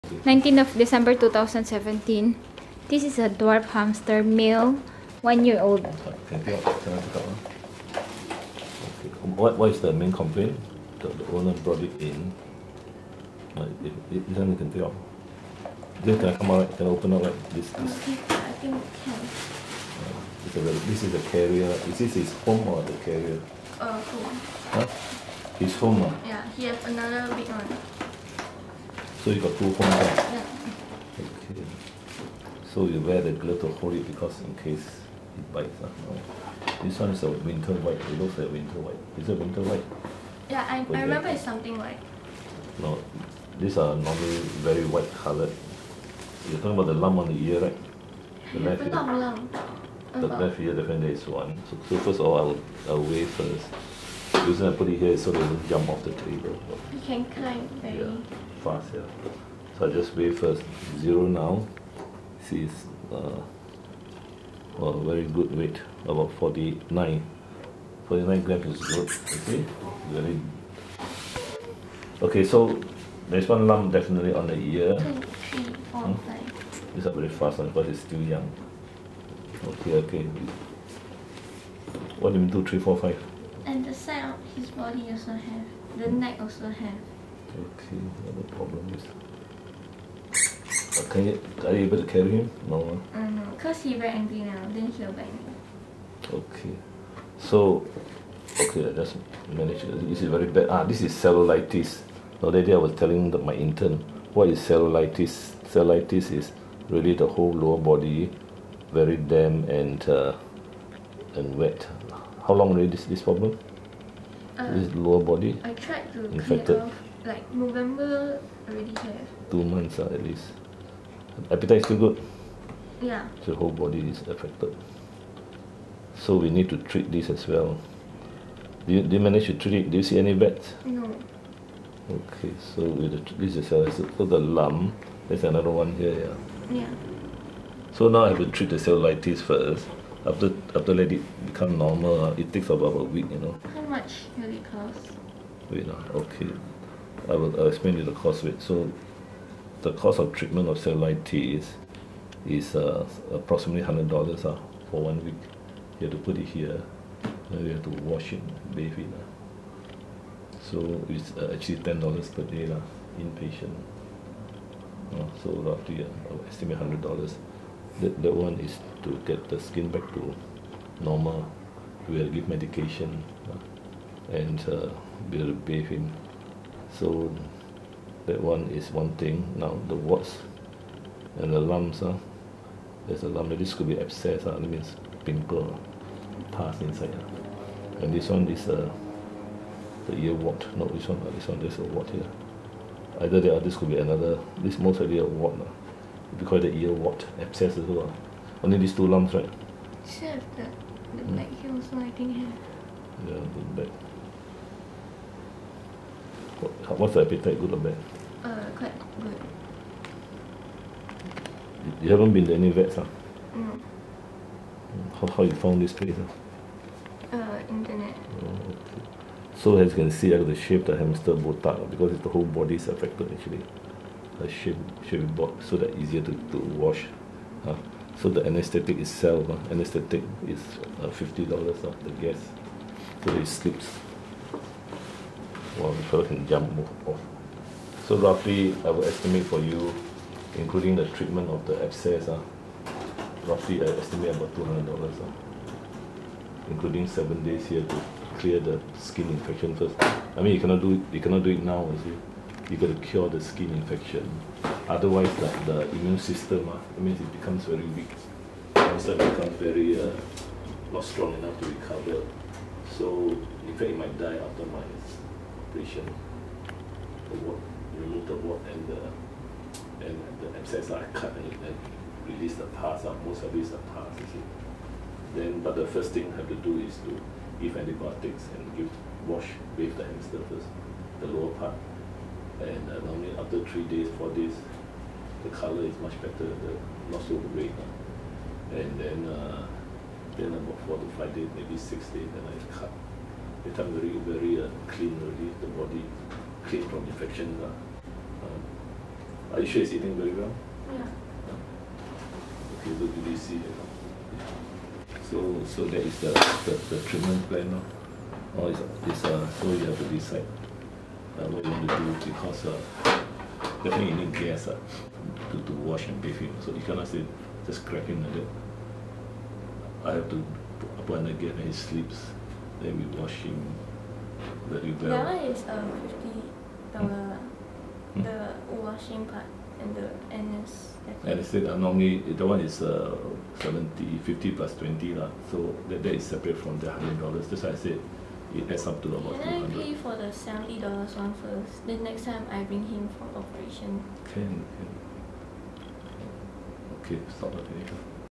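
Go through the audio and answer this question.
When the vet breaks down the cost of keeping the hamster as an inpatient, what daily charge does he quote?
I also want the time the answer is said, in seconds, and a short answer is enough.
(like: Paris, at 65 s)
$10 per day, at 161 s.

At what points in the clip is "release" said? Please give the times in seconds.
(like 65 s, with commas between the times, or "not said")
272 s.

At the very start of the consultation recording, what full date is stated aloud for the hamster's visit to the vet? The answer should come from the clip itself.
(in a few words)
19 December 2017.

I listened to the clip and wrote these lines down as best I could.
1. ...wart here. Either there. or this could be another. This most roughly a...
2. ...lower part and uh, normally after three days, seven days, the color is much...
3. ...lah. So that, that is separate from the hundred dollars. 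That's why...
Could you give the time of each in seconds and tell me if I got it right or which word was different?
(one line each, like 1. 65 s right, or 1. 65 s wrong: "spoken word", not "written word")
1. 191 s wrong: "likely", not "roughly"
2. 281 s wrong: "four", not "seven"
3. 335 s right.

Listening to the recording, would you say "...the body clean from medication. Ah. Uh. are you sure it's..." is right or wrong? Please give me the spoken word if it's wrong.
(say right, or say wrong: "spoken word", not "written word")
wrong: "infection", not "medication".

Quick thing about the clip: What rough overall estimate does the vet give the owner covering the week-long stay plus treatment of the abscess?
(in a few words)
$200.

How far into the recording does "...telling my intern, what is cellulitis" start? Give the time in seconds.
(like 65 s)
102 s.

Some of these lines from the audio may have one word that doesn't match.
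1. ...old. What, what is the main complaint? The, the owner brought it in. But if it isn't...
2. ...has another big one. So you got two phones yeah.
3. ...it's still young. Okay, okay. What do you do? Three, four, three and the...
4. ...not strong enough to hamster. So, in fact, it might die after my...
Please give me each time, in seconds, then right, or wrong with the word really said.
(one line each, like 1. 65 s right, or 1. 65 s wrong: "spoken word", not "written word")
1. 5 s right
2. 26 s right
3. 77 s wrong: "five", not "three"
4. 260 s wrong: "recover", not "hamster".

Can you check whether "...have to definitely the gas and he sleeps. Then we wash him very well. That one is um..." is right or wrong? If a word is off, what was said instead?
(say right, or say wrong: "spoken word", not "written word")
wrong: "apply", not "definitely".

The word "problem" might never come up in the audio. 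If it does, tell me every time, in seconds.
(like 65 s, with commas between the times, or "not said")
88 s, 113 s.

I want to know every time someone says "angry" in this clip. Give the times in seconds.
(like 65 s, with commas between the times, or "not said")
94 s.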